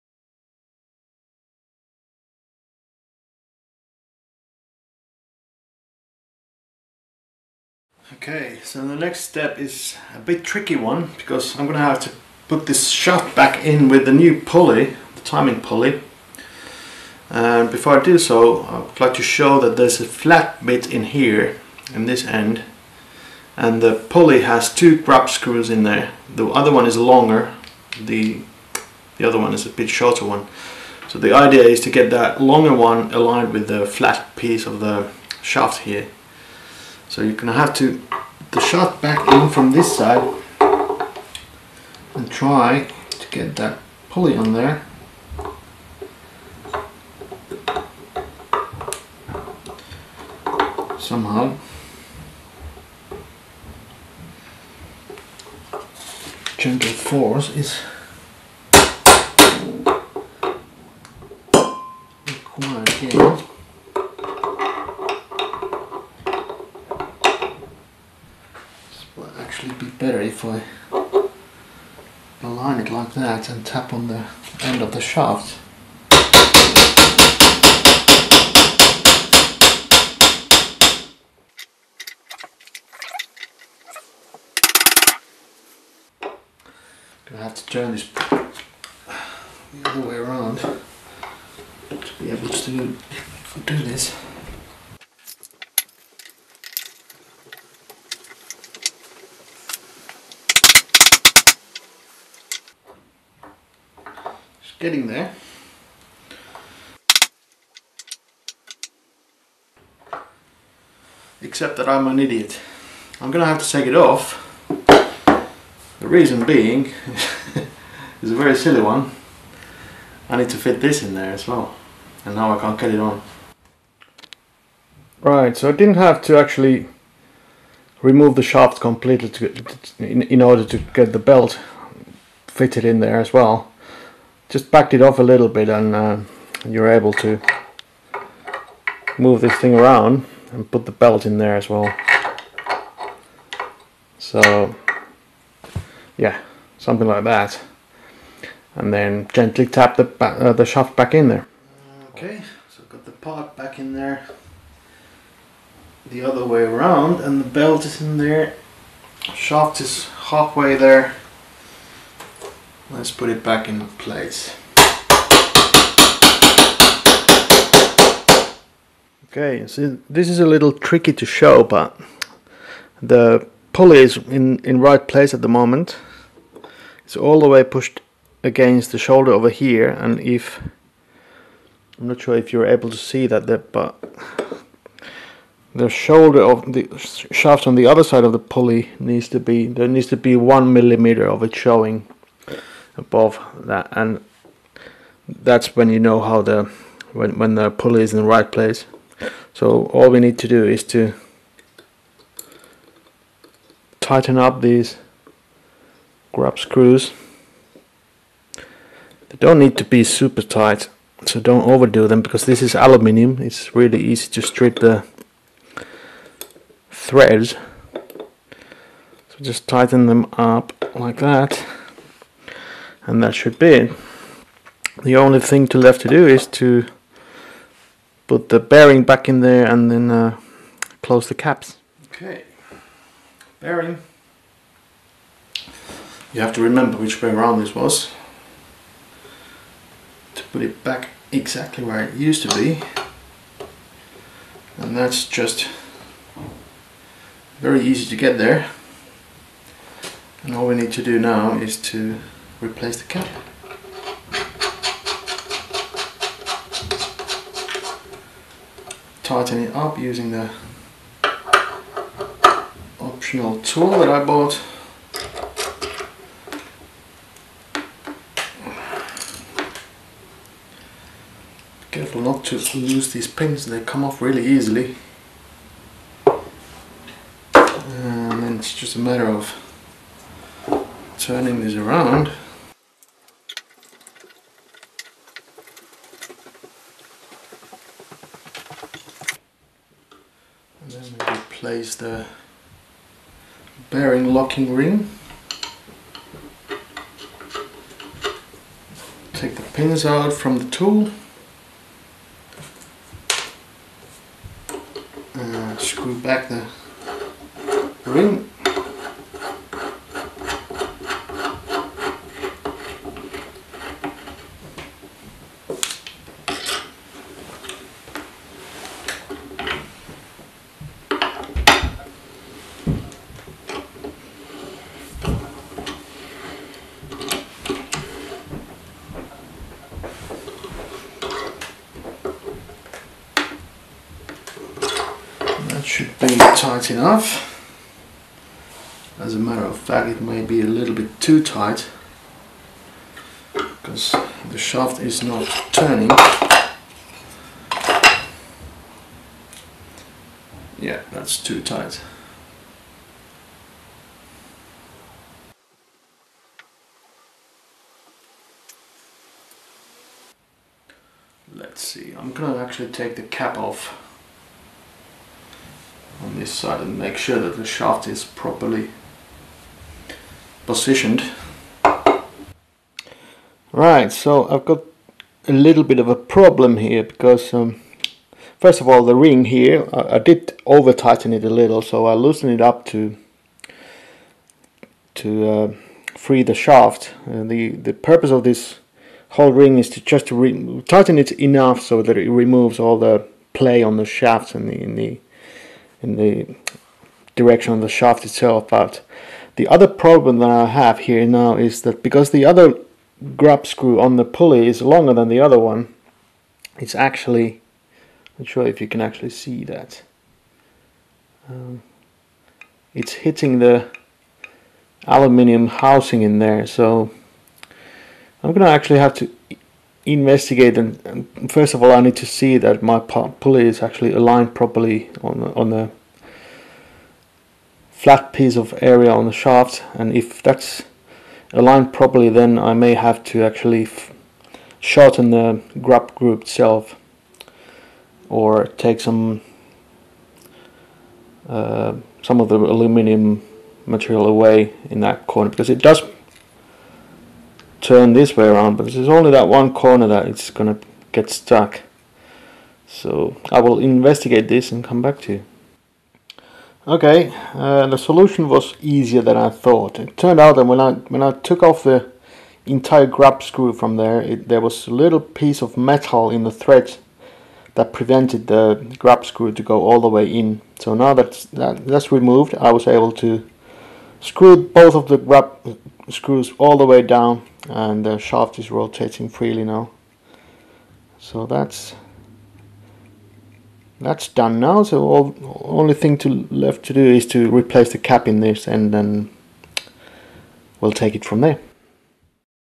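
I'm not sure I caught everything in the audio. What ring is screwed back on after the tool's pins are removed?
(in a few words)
bearing locking ring.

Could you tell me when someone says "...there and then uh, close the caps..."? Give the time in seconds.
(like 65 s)
229 s.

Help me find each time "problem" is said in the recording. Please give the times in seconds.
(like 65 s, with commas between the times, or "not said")
376 s, 399 s.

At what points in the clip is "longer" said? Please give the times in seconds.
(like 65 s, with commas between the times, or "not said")
26 s, 32 s, 404 s.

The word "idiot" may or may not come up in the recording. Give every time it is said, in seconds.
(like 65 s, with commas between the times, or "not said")
112 s.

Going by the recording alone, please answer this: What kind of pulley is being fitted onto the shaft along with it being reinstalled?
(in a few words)
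timing pulley.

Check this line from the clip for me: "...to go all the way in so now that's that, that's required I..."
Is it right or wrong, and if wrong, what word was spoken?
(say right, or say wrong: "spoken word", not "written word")
wrong: "removed", not "required".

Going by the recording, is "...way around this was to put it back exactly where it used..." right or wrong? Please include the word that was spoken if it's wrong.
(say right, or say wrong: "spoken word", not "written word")
right.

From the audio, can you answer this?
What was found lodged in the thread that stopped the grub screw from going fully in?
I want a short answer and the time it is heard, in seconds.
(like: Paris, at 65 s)
a little piece of metal, at 464 s.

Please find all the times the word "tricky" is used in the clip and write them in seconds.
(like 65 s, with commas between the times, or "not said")
10 s, 170 s.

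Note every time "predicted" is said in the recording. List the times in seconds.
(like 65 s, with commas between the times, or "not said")
not said.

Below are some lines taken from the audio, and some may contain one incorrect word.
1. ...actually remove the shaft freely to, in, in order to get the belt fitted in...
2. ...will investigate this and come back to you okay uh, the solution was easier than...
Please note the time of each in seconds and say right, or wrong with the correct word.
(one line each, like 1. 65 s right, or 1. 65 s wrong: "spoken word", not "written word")
1. 126 s wrong: "completely", not "freely"
2. 453 s right.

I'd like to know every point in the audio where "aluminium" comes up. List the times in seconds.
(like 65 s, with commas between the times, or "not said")
212 s, 415 s, 442 s.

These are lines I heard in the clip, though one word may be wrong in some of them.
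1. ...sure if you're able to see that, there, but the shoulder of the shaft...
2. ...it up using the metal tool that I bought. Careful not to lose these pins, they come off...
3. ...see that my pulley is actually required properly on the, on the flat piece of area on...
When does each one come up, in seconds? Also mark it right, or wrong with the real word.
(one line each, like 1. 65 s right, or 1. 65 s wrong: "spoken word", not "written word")
1. 182 s right
2. 259 s wrong: "optional", not "metal"
3. 422 s wrong: "aligned", not "required".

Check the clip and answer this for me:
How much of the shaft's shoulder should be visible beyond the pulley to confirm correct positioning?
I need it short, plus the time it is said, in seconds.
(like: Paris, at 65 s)
1 millimeter, at 190 s.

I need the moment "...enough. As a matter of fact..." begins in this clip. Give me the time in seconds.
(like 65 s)
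336 s.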